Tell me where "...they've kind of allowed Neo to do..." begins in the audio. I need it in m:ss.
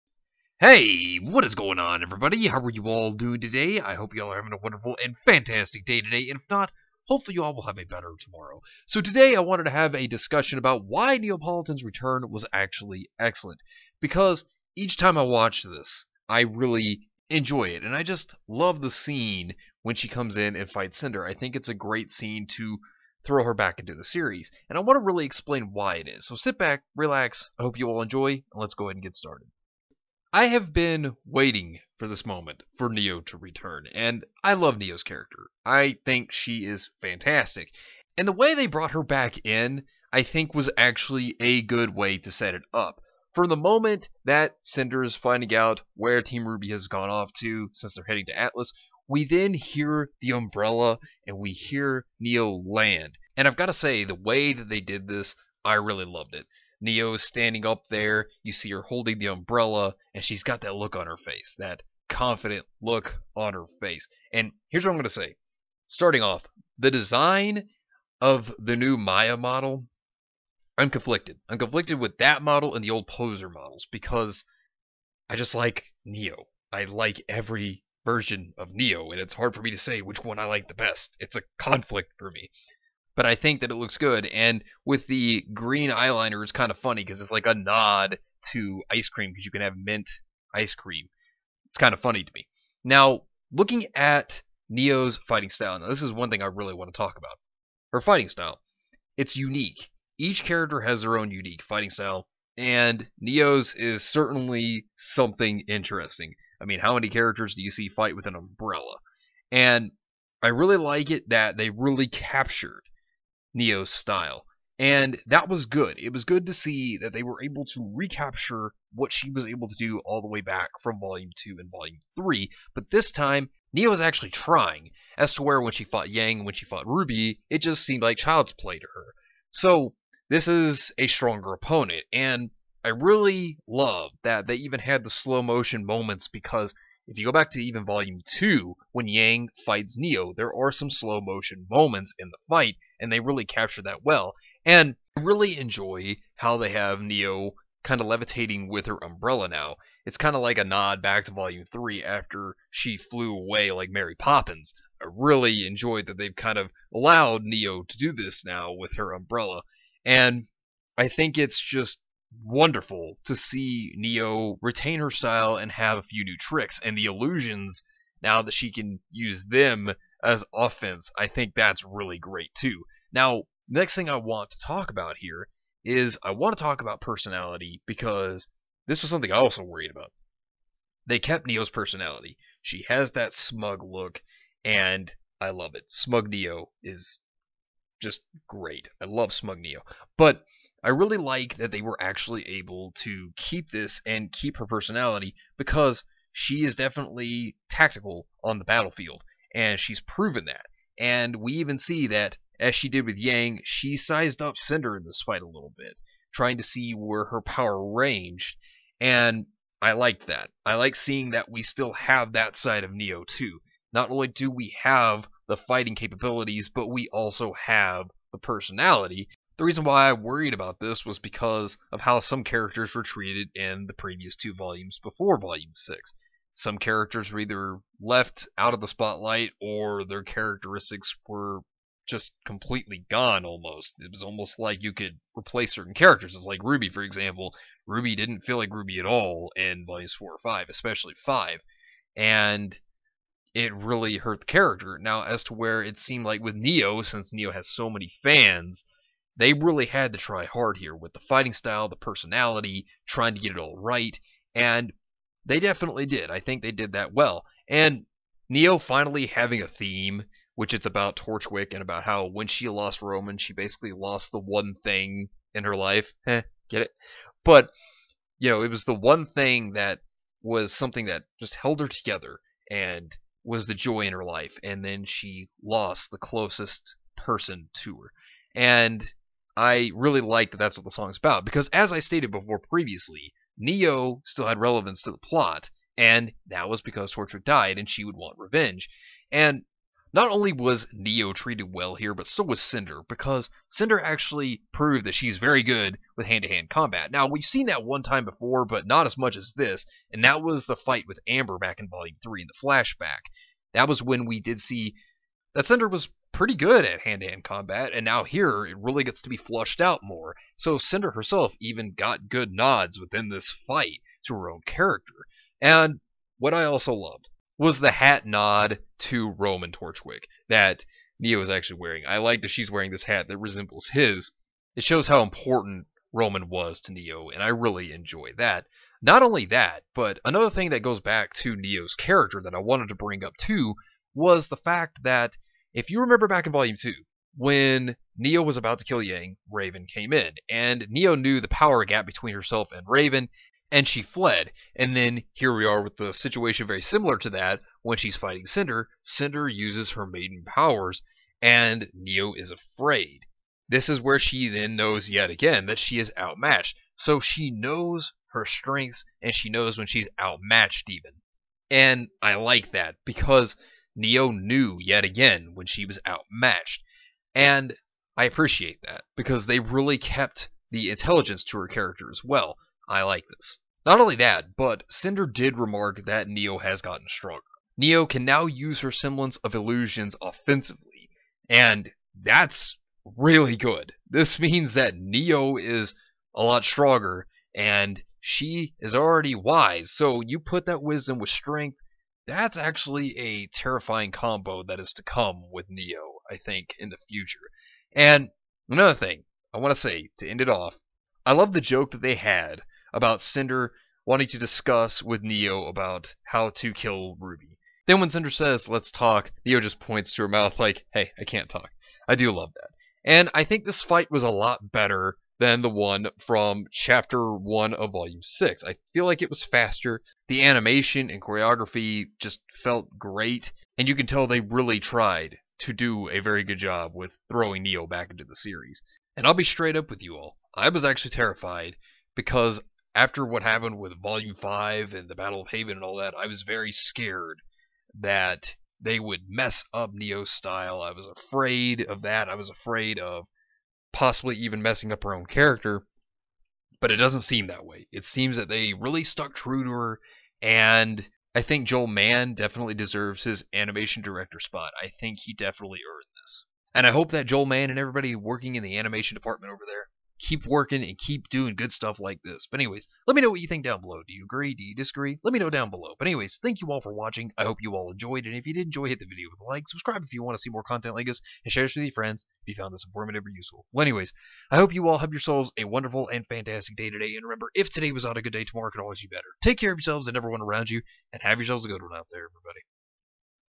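2:36.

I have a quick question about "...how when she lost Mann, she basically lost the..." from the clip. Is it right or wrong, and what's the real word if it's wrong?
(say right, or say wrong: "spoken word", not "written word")
wrong: "Roman", not "Mann".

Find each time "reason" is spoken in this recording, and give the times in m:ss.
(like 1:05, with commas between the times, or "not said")
3:39.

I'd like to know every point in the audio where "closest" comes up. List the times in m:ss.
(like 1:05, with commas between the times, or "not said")
4:36.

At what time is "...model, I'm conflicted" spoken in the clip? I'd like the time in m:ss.
1:09.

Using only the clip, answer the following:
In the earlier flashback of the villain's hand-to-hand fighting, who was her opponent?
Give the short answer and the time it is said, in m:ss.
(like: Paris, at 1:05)
Amber, at 5:01.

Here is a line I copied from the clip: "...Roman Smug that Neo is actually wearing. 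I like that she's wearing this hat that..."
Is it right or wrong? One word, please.
wrong.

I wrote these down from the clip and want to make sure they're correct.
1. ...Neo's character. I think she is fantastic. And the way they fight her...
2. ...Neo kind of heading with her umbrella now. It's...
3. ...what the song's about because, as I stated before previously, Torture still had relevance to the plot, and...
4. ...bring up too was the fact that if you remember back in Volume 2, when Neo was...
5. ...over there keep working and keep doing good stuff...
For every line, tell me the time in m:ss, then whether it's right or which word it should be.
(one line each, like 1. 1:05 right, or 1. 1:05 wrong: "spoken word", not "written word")
1. 0:34 wrong: "brought", not "fight"
2. 2:27 wrong: "levitating", not "heading"
3. 4:40 wrong: "Neo", not "Torture"
4. 5:32 right
5. 7:39 right.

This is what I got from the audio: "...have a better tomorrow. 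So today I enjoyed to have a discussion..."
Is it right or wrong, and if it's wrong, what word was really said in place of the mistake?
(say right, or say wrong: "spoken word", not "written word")
wrong: "wanted", not "enjoyed".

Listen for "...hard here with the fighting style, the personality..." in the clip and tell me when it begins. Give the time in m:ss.
4:10.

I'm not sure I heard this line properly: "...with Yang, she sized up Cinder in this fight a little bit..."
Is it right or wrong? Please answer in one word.
right.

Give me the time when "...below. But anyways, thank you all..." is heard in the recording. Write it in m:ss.
7:45.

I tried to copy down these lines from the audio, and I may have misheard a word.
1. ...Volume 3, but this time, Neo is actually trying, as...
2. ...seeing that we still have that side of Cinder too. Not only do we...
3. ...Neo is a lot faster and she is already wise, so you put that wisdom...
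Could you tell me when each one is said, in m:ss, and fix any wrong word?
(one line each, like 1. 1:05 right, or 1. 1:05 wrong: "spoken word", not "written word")
1. 2:01 right
2. 3:30 wrong: "Neo", not "Cinder"
3. 6:24 wrong: "stronger", not "faster".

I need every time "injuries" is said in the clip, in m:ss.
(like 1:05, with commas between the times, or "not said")
not said.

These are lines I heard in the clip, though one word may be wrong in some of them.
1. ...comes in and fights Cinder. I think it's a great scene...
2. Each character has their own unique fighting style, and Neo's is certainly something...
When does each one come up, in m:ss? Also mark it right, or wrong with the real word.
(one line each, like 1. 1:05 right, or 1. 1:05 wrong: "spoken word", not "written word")
1. 0:20 right
2. 1:40 right.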